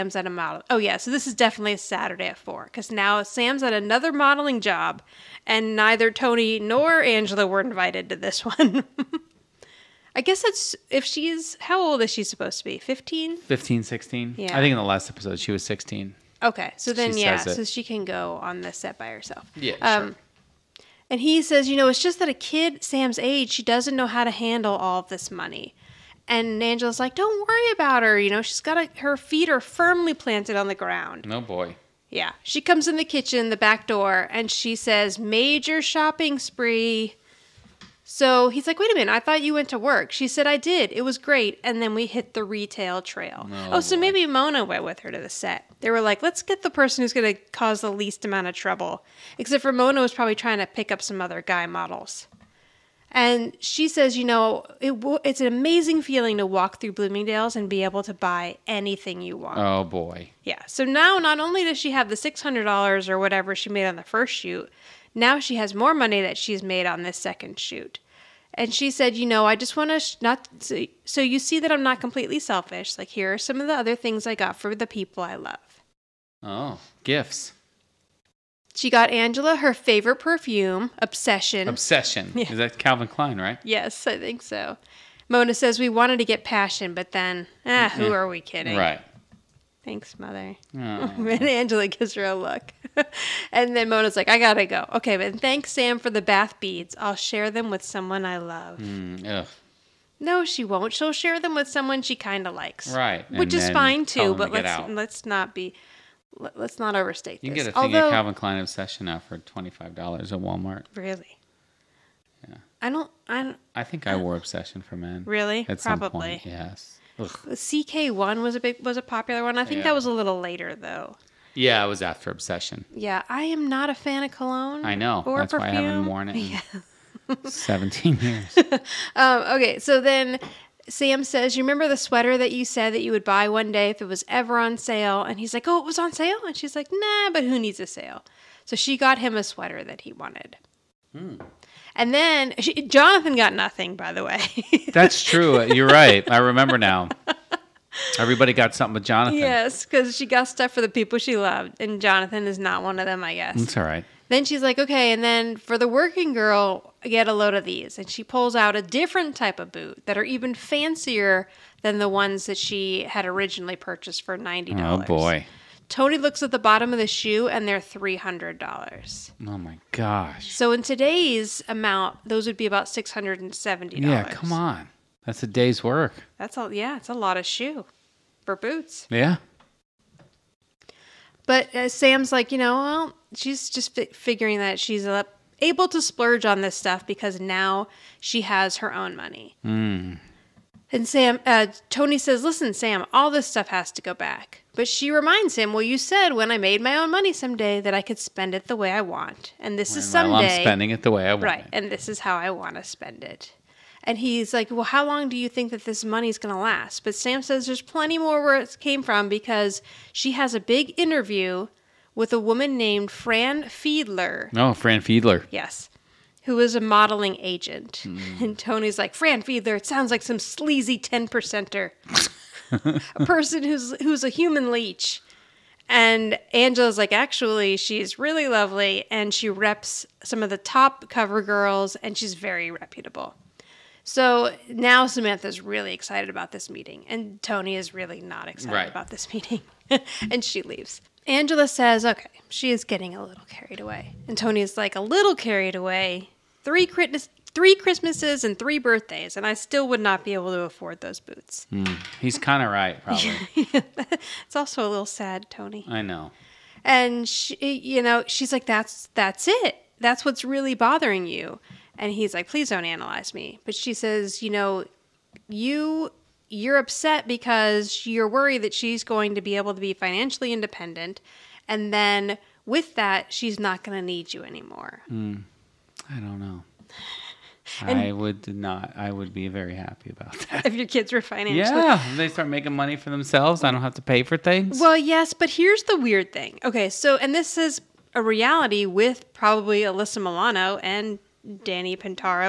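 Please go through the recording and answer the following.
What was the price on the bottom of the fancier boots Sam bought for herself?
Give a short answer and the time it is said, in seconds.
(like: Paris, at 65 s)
$300, at 167 s.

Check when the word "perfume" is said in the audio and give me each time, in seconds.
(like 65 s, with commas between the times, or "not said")
80 s, 125 s.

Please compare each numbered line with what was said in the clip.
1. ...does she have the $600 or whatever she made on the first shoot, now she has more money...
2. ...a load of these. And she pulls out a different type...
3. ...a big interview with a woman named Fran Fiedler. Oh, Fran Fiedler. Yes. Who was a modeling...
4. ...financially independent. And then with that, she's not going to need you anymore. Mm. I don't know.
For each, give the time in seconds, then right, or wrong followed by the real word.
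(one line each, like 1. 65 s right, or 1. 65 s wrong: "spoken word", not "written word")
1. 61 s right
2. 157 s right
3. 210 s right
4. 269 s right.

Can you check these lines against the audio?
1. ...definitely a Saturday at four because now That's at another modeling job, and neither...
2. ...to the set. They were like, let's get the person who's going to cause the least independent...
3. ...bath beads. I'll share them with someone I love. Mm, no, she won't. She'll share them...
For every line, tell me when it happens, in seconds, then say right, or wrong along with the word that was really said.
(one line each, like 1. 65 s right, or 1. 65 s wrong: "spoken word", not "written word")
1. 1 s wrong: "Sam", not "That"
2. 45 s wrong: "amount", not "independent"
3. 96 s right.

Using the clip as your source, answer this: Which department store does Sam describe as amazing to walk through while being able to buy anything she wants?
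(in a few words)
Bloomingdale's.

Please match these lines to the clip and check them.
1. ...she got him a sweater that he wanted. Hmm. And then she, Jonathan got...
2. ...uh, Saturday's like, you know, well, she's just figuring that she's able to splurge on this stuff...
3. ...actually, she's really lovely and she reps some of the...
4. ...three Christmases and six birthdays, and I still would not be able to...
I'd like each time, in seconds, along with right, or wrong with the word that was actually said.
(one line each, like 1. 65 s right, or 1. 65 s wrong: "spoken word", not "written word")
1. 138 s right
2. 181 s wrong: "Sam", not "Saturday"
3. 227 s right
4. 247 s wrong: "three", not "six".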